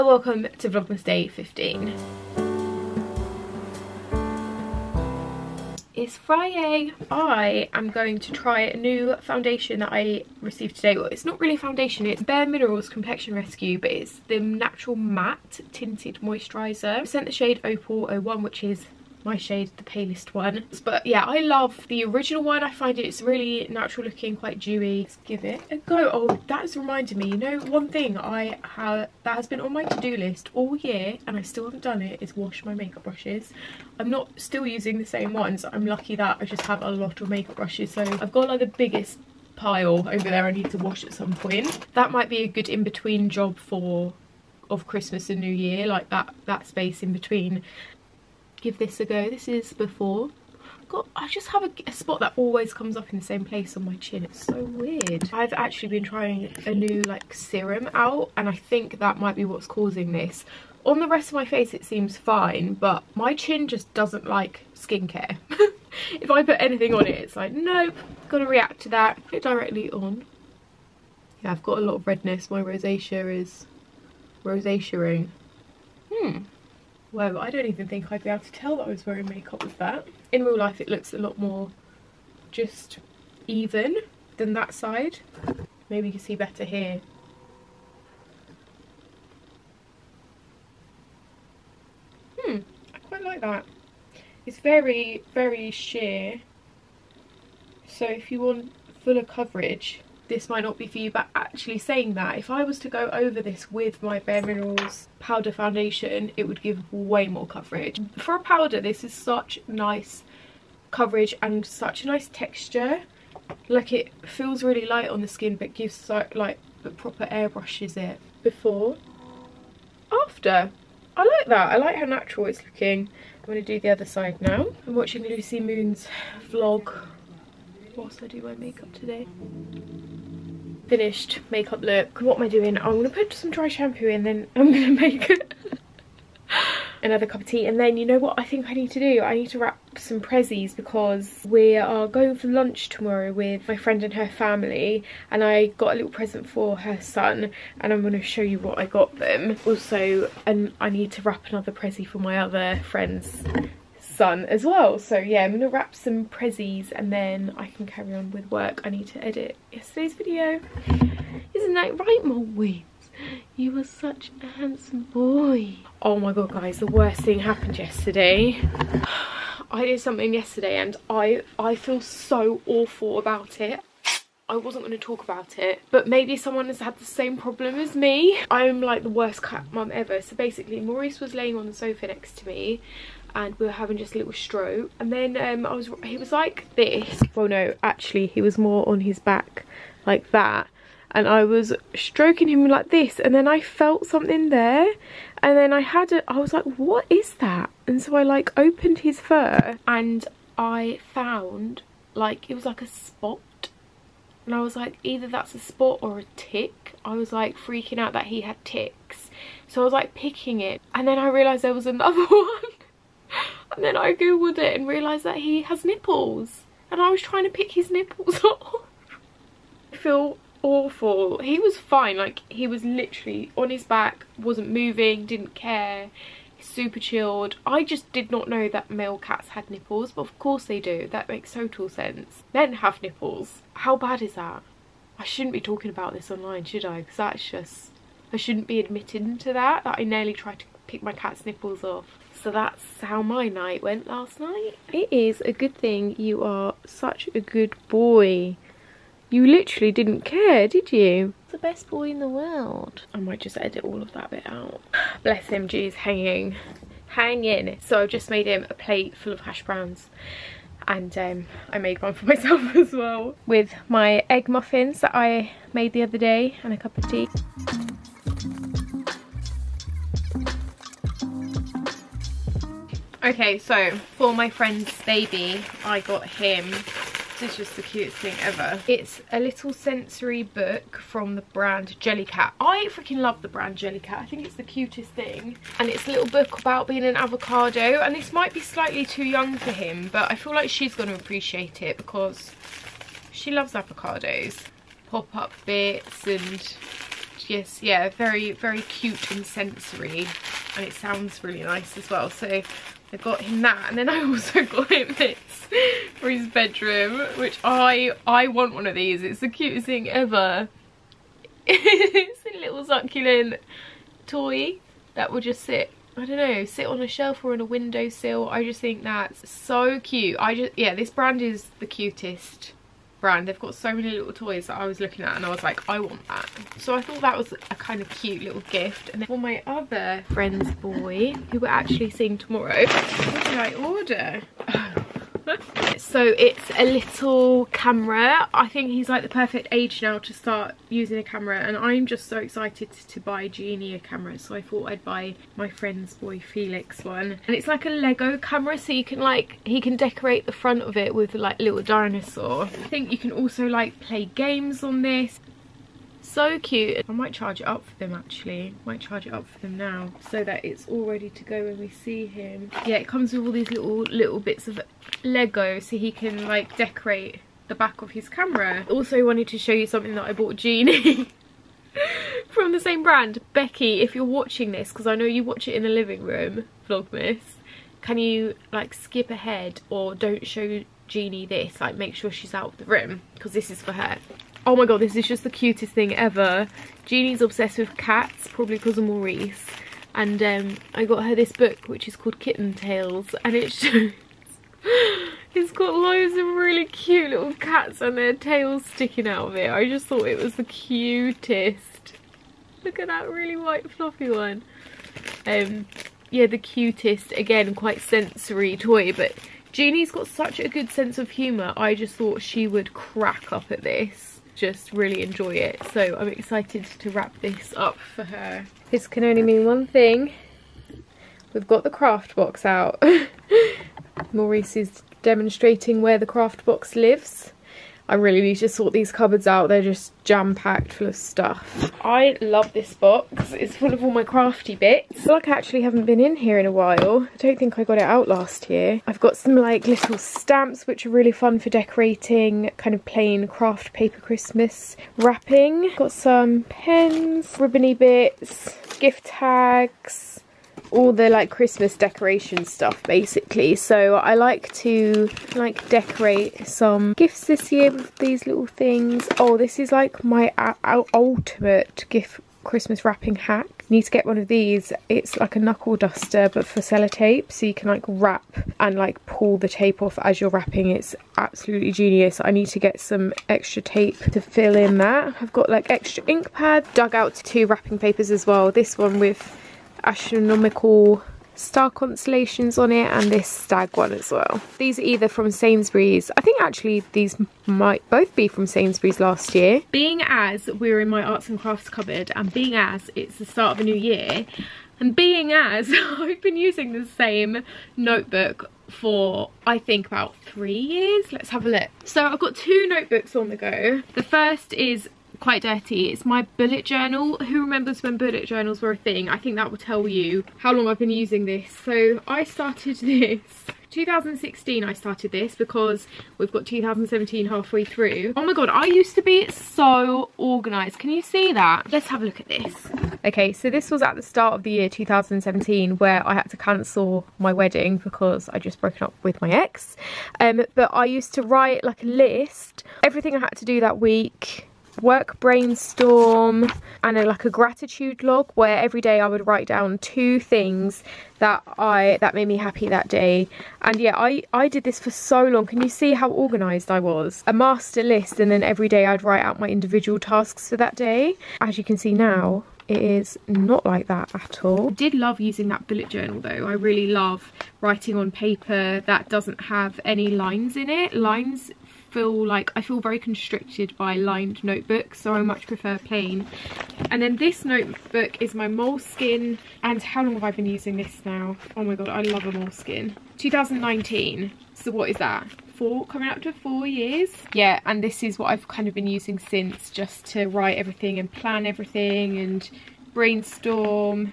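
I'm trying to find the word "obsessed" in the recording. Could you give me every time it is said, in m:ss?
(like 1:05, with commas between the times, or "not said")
6:27.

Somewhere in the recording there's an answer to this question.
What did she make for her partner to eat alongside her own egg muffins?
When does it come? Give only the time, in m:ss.
4:19.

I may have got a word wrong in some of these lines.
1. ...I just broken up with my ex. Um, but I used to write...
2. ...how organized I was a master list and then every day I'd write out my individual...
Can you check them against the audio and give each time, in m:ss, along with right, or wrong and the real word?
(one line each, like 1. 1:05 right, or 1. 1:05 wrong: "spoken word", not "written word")
1. 8:48 right
2. 9:06 right.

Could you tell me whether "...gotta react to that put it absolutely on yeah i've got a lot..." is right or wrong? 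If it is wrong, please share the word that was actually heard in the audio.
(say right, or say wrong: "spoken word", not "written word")
wrong: "directly", not "absolutely".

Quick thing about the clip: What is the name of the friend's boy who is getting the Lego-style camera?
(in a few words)
Felix.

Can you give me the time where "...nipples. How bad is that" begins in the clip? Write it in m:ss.
3:53.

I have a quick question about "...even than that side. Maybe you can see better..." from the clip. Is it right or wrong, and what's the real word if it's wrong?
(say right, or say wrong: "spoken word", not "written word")
right.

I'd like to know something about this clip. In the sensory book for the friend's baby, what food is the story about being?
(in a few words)
an avocado.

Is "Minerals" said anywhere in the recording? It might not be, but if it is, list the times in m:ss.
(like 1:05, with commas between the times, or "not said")
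0:12, 1:44.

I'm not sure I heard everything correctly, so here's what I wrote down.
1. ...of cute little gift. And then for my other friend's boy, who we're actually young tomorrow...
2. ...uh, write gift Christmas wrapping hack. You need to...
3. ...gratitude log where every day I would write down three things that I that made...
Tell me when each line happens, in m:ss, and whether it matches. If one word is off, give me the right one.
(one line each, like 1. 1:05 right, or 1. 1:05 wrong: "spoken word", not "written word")
1. 5:28 wrong: "seeing", not "young"
2. 7:40 wrong: "ultimate", not "write"
3. 8:57 wrong: "two", not "three".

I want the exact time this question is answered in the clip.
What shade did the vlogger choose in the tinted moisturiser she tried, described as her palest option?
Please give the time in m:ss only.
0:17.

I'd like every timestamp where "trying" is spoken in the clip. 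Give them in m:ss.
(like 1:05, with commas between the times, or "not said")
0:56, 3:37.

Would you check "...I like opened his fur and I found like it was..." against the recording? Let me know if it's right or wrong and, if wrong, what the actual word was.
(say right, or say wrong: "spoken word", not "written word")
right.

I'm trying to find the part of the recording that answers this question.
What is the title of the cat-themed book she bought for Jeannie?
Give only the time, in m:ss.
6:32.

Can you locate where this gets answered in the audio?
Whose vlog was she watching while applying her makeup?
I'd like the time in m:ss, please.
2:05.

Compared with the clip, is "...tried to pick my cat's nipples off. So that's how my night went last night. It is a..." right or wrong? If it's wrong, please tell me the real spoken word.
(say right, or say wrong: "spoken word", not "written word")
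right.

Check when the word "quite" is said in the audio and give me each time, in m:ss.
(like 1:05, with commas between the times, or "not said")
0:24, 1:33, 6:47, 8:25.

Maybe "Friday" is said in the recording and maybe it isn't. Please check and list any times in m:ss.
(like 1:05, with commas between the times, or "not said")
0:06.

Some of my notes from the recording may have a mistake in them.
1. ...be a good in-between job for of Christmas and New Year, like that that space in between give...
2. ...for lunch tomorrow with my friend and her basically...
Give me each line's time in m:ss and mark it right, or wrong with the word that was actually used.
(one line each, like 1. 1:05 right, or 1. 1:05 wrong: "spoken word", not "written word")
1. 0:42 right
2. 2:22 wrong: "family", not "basically".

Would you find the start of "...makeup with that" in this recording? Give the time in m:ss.
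1:19.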